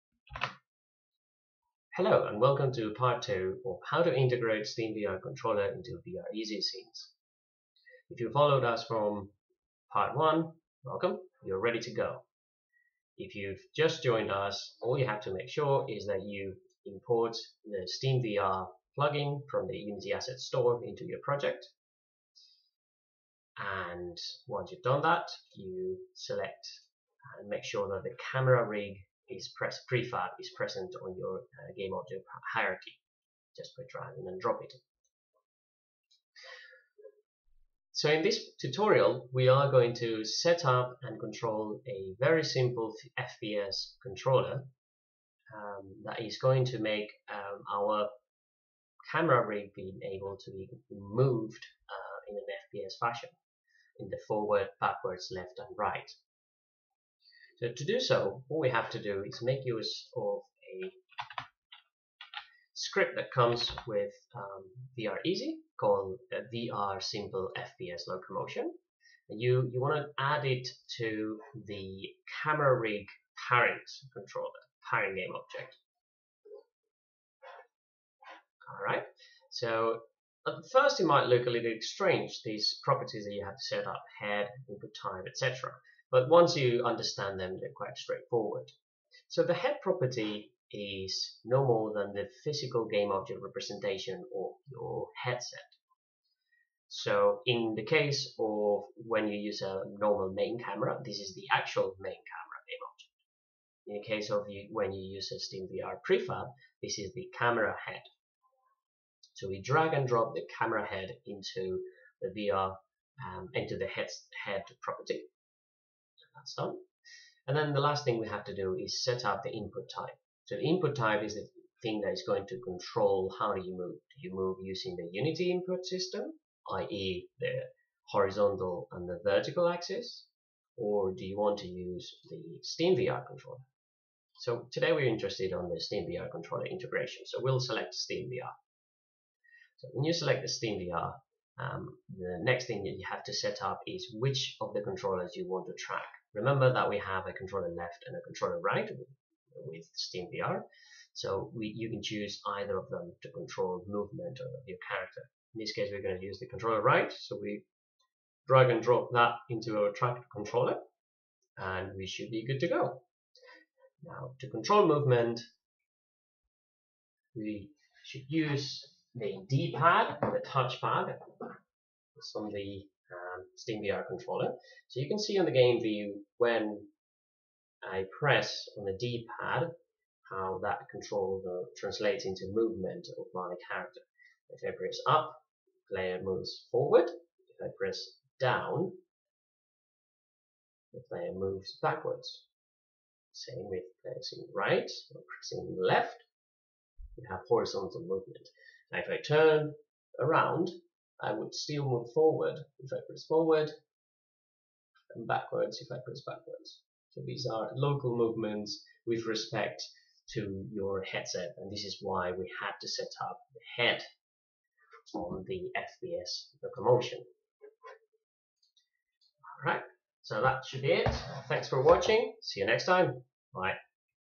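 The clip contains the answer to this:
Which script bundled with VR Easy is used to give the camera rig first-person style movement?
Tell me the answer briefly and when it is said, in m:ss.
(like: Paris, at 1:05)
VR Simple FPS Locomotion, at 1:06.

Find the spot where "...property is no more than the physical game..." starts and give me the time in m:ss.
1:29.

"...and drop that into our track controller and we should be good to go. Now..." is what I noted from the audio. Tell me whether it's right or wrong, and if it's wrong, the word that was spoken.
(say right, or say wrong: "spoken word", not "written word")
right.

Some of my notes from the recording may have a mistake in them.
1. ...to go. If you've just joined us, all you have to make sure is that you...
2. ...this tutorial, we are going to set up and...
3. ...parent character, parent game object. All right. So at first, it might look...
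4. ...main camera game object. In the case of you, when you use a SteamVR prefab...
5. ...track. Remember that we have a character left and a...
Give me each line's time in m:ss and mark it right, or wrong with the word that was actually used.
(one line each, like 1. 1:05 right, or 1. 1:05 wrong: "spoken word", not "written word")
1. 0:11 right
2. 0:38 right
3. 1:13 wrong: "controller", not "character"
4. 1:41 right
5. 2:25 wrong: "controller", not "character".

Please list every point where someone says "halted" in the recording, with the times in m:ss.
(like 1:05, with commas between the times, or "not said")
not said.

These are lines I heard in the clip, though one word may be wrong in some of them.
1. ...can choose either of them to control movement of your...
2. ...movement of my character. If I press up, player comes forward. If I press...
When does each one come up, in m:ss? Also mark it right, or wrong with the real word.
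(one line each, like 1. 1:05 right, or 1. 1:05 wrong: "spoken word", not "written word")
1. 2:31 right
2. 3:02 wrong: "moves", not "comes".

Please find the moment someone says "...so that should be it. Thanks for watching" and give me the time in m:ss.
3:40.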